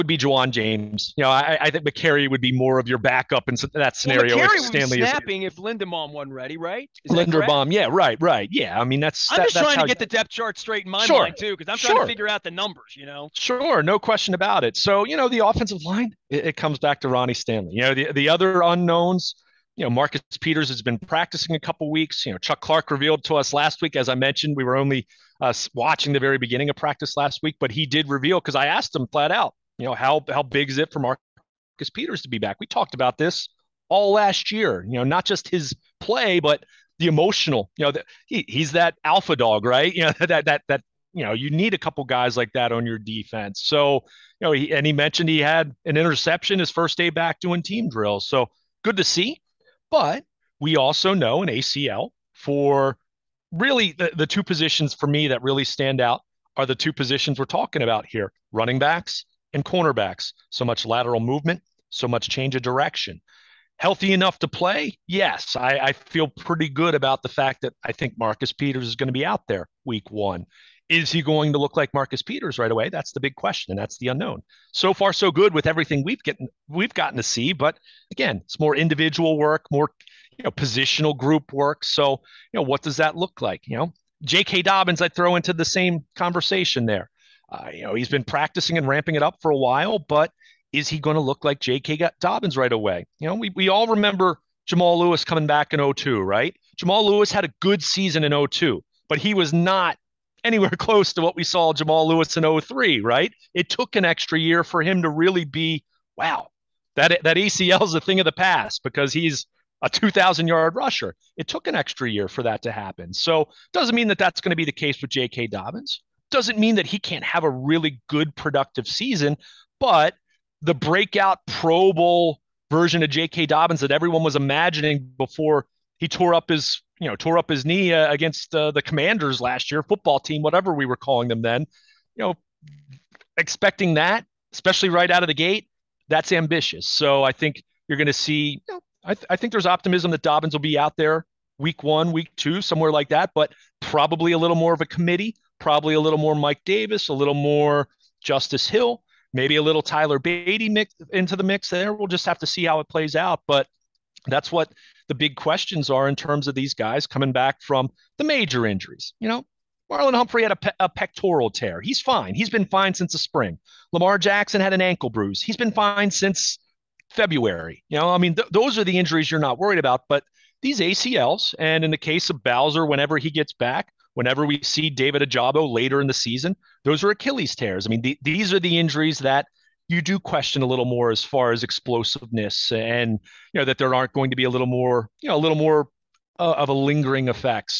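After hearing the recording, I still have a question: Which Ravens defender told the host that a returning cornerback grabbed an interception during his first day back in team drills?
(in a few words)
Chuck Clark.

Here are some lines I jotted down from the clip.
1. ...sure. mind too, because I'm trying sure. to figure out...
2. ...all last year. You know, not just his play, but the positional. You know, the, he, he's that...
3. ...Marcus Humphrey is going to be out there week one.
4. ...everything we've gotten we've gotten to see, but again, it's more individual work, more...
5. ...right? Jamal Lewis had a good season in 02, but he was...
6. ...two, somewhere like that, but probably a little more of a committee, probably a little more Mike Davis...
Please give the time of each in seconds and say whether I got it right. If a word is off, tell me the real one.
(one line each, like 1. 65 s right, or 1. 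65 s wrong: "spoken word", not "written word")
1. 11 s right
2. 33 s wrong: "emotional", not "positional"
3. 68 s wrong: "Peters", not "Humphrey"
4. 75 s right
5. 96 s right
6. 142 s right.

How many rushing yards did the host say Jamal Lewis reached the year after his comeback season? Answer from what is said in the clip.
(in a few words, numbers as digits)
2,000.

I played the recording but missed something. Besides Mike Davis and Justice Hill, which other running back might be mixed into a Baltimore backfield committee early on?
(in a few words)
Tyler Badie.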